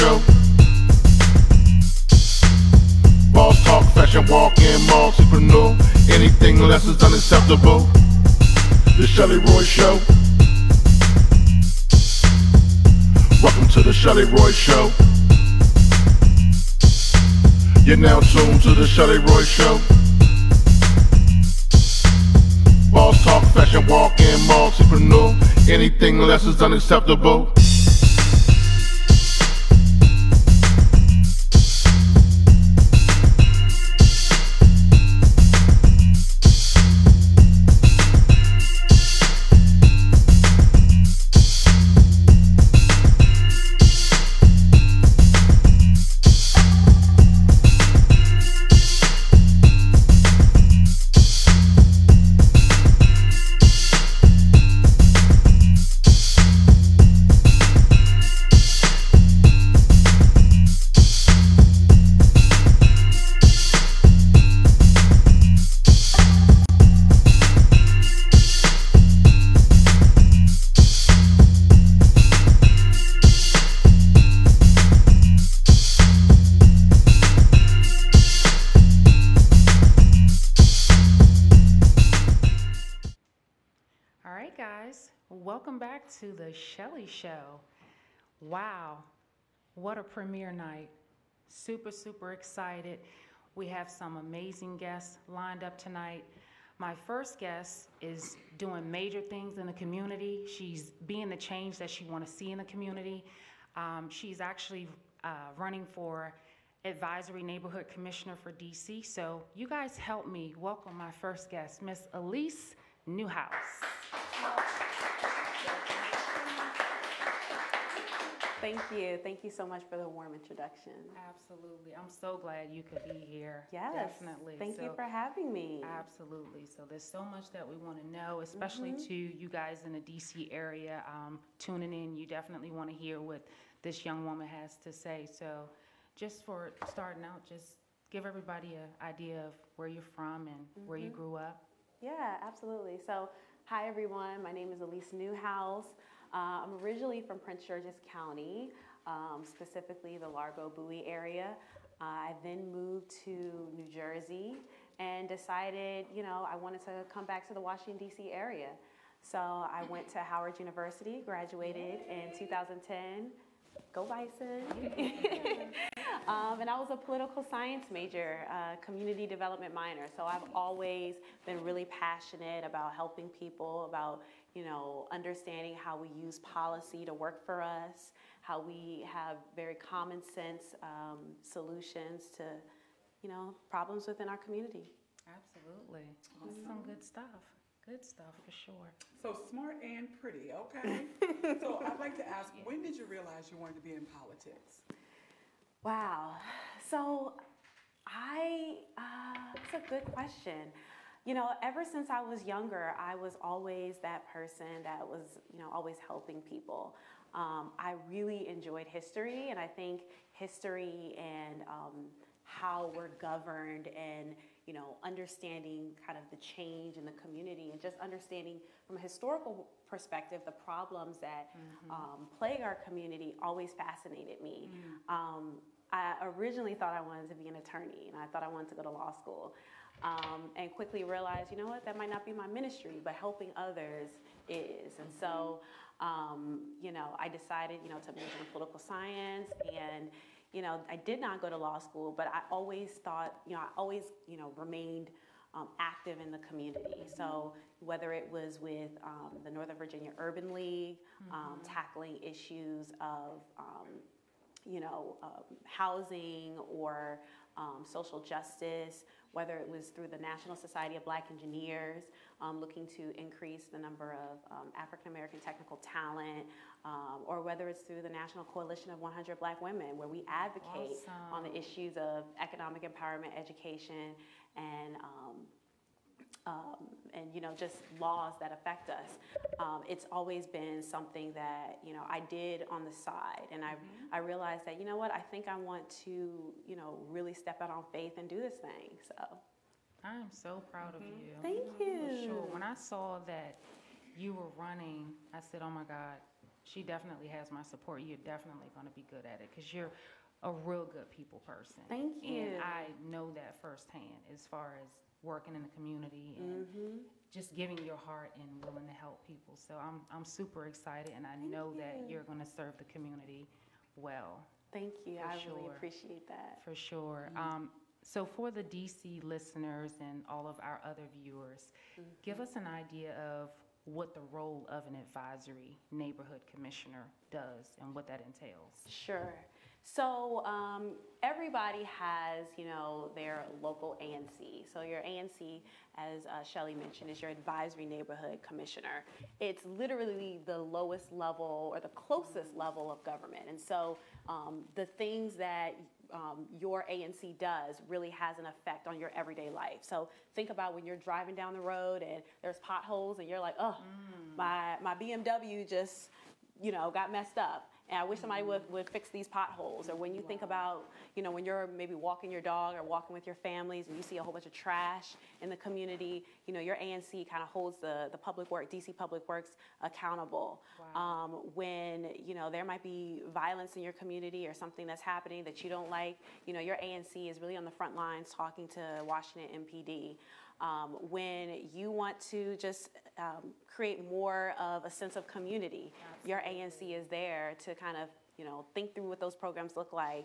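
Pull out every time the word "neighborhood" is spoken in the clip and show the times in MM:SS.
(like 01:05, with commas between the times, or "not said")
01:47, 05:25, 05:37.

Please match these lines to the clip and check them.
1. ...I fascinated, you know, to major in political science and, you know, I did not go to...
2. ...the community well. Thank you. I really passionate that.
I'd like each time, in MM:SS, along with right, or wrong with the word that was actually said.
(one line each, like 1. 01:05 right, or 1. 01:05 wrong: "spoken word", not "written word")
1. 03:57 wrong: "decided", not "fascinated"
2. 05:12 wrong: "appreciate", not "passionate".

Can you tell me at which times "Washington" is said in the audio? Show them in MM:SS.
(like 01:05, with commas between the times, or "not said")
02:37, 06:19.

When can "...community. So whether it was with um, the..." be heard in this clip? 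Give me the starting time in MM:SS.
04:06.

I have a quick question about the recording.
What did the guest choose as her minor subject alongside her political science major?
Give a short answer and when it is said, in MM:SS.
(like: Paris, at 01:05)
community development, at 02:48.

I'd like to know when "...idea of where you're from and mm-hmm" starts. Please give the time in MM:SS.
02:19.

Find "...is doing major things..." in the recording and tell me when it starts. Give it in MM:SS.
01:38.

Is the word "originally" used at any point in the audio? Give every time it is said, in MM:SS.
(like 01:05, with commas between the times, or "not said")
02:26, 03:46.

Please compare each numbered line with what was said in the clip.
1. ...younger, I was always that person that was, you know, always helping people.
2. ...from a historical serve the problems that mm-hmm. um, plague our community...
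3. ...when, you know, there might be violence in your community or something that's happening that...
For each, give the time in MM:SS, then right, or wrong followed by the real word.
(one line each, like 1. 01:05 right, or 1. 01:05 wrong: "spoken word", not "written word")
1. 03:22 right
2. 03:38 wrong: "perspective", not "serve"
3. 06:11 right.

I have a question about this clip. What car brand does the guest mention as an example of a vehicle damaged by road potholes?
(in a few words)
BMW.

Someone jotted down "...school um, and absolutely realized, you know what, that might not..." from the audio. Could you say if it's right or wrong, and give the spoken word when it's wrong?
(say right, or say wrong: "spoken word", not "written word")
wrong: "quickly", not "absolutely".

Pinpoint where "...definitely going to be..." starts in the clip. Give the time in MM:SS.
04:58.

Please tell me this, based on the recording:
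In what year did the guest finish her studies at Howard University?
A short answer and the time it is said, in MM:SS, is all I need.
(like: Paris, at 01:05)
2010, at 02:42.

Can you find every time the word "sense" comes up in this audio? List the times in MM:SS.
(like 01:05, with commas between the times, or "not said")
03:00, 06:24.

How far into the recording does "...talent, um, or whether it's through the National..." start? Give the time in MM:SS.
04:25.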